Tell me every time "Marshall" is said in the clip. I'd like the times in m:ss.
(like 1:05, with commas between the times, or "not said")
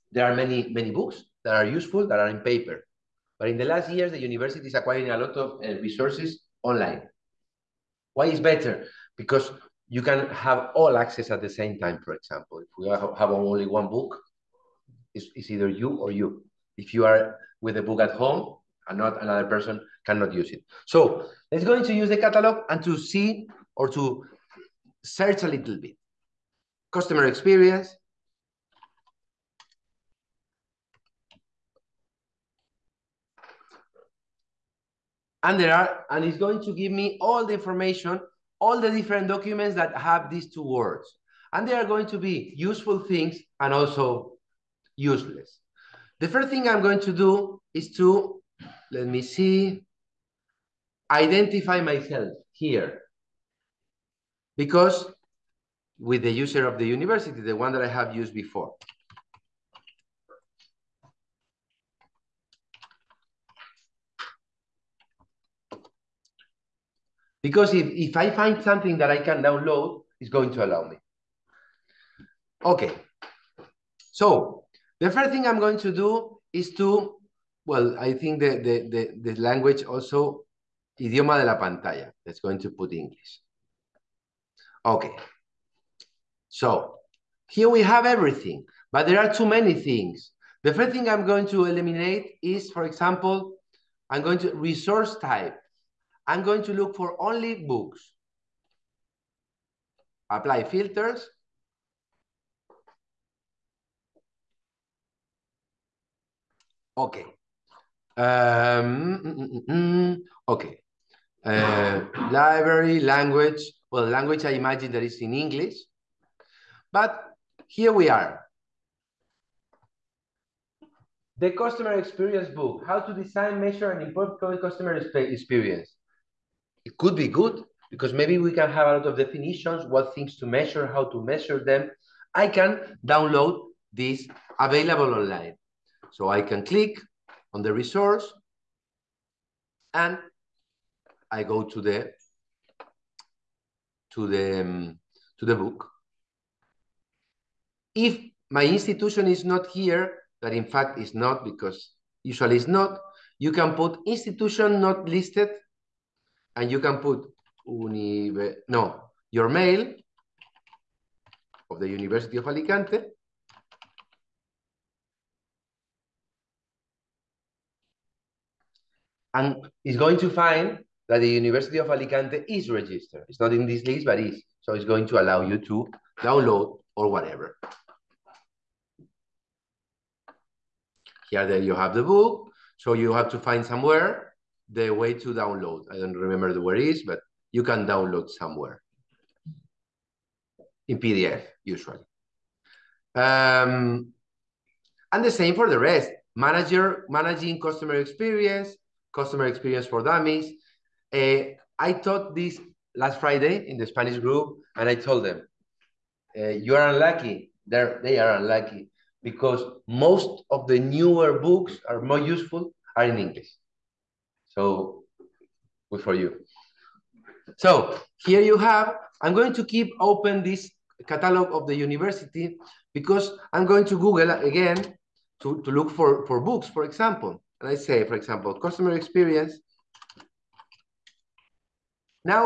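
not said.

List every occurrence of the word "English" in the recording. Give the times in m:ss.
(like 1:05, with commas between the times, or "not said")
1:22, 1:55, 3:33.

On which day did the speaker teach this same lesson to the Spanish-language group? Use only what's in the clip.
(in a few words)
Last Friday.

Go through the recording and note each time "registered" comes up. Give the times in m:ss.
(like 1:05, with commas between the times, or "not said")
2:52.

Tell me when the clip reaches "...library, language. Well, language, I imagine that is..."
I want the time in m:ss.
1:52.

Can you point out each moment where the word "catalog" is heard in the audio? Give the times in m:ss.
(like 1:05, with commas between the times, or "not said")
0:22, 3:41.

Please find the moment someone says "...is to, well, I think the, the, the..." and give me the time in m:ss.
1:16.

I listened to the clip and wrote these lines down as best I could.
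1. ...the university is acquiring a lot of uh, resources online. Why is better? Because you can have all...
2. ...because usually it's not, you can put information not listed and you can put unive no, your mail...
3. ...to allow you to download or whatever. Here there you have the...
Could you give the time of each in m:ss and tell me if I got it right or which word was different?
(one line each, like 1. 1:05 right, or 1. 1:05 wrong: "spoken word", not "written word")
1. 0:04 right
2. 2:31 wrong: "institution", not "information"
3. 2:55 right.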